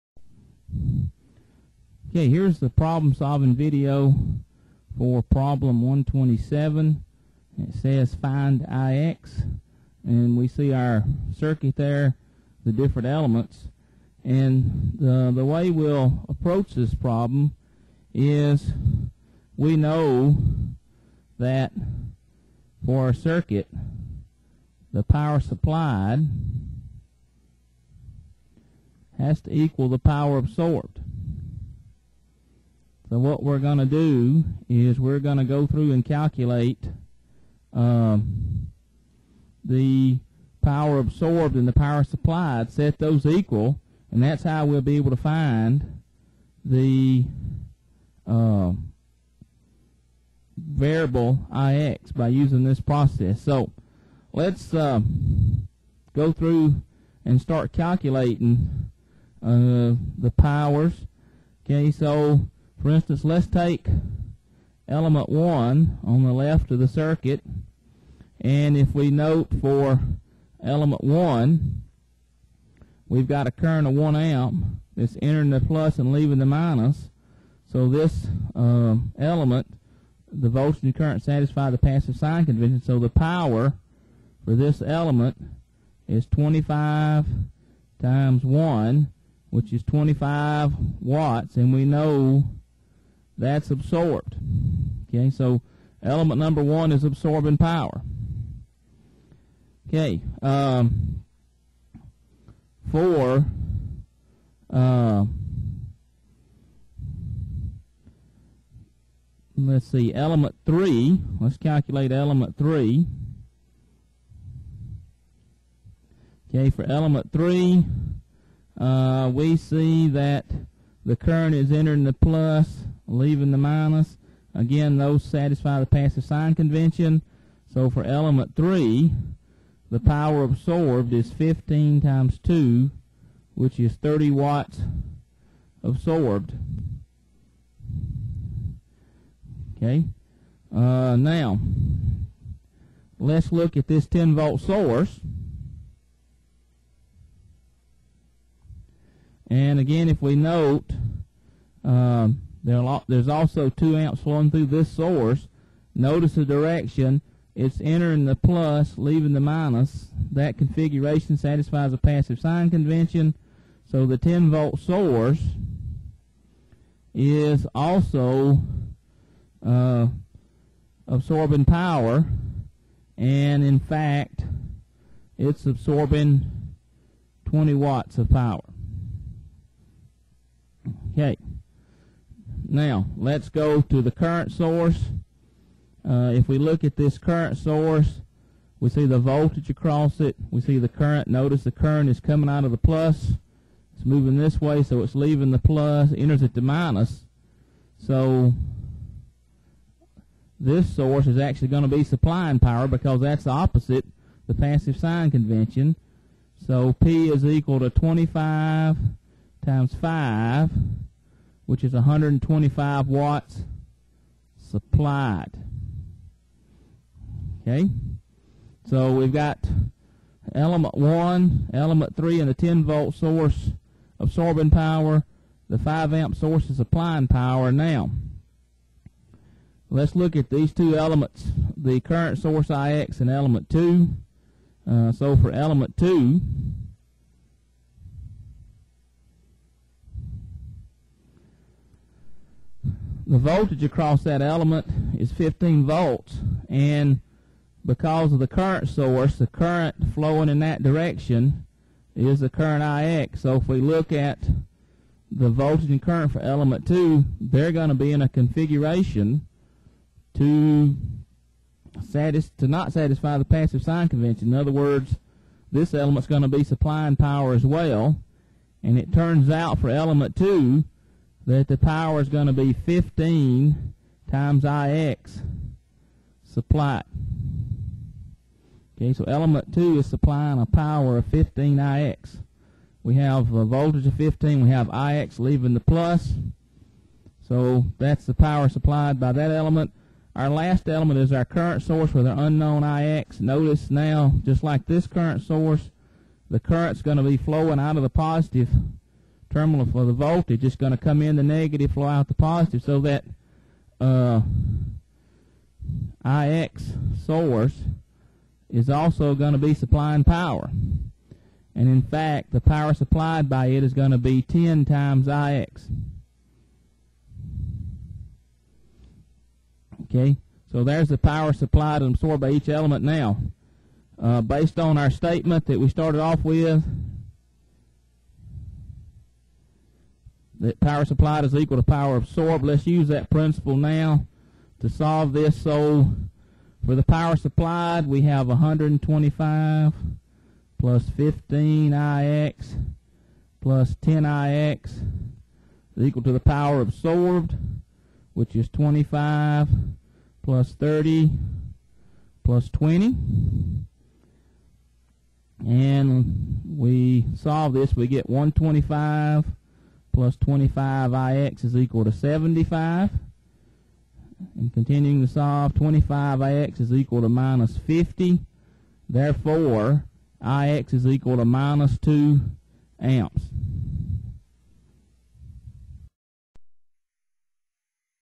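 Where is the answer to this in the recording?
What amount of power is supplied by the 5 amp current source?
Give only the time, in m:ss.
3:31.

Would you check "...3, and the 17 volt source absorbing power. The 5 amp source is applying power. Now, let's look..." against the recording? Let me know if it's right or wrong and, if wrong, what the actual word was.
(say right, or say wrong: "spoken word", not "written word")
wrong: "10", not "17".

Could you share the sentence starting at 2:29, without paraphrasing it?
And again, if we note, um, there's also two amps flowing through this source.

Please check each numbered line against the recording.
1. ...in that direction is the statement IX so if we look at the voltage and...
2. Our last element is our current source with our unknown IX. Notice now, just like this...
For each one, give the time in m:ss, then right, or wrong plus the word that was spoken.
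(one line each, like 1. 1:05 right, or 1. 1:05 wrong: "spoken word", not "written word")
1. 4:10 wrong: "current", not "statement"
2. 4:50 right.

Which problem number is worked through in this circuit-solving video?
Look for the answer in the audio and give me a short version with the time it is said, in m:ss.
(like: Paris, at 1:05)
127, at 0:05.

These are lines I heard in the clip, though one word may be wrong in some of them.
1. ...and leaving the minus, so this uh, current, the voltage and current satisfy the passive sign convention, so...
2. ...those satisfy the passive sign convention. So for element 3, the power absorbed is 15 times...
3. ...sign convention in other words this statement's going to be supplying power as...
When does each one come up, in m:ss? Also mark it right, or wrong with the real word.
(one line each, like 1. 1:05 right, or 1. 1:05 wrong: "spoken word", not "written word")
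1. 1:15 wrong: "element", not "current"
2. 2:04 right
3. 4:23 wrong: "element", not "statement".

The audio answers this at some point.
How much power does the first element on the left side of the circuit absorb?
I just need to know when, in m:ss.
1:29.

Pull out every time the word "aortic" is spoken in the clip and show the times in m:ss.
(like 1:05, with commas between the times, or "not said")
not said.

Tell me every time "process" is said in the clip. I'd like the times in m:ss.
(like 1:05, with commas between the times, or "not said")
0:52.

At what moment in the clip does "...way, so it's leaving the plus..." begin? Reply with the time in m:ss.
3:14.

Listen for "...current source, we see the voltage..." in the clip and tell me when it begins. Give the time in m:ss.
3:07.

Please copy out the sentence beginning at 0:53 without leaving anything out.
So let's uh, go through and start calculating uh, the powers.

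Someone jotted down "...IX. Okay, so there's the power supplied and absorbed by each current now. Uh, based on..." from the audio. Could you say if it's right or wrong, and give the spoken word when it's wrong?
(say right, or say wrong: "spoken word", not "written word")
wrong: "element", not "current".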